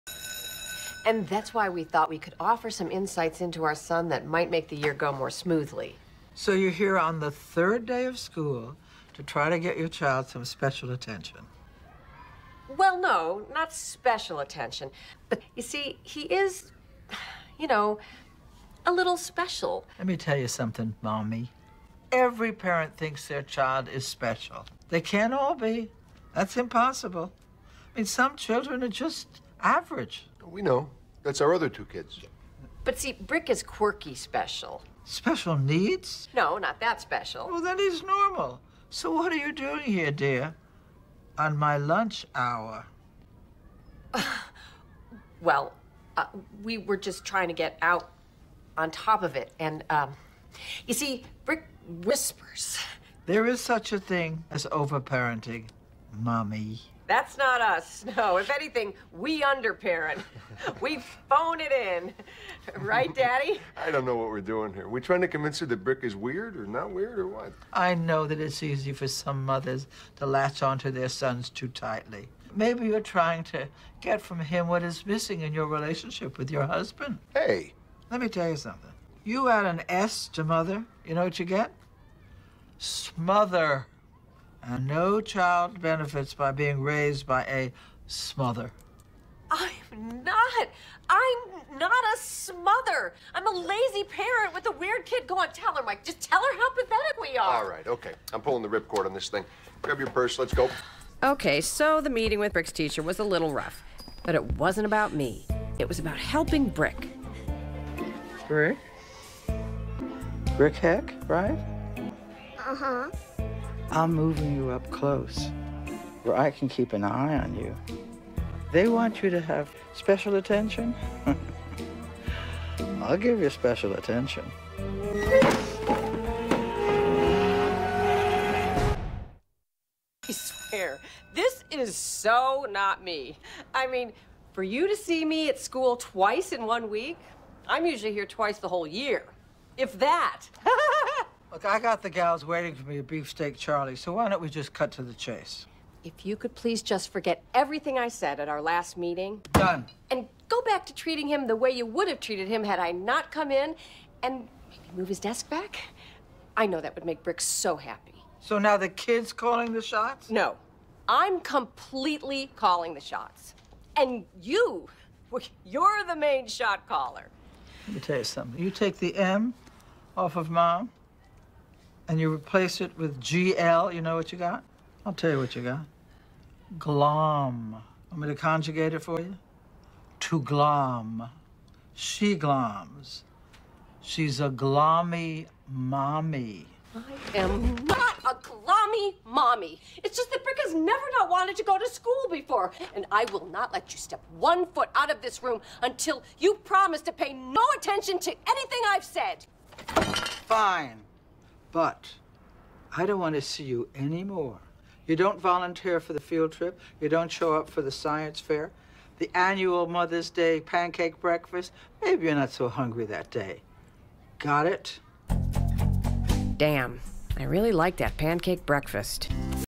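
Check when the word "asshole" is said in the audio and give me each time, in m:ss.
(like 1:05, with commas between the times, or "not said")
not said.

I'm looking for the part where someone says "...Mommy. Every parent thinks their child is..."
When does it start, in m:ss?
0:21.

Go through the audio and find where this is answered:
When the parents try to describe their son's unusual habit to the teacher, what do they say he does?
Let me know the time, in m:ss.
0:51.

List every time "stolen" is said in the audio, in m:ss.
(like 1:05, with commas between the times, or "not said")
not said.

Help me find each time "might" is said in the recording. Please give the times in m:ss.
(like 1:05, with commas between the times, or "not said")
0:04.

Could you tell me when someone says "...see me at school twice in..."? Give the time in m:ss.
2:14.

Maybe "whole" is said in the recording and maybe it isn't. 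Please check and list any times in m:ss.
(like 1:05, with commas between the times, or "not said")
2:18.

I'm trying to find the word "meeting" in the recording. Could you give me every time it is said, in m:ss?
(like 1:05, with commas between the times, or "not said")
1:42, 2:28.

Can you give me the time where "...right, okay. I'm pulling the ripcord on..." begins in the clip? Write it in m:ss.
1:37.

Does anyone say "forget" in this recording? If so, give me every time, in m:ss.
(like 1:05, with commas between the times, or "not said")
2:27.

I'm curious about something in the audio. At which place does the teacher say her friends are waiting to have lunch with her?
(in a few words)
Beefsteak Charlie.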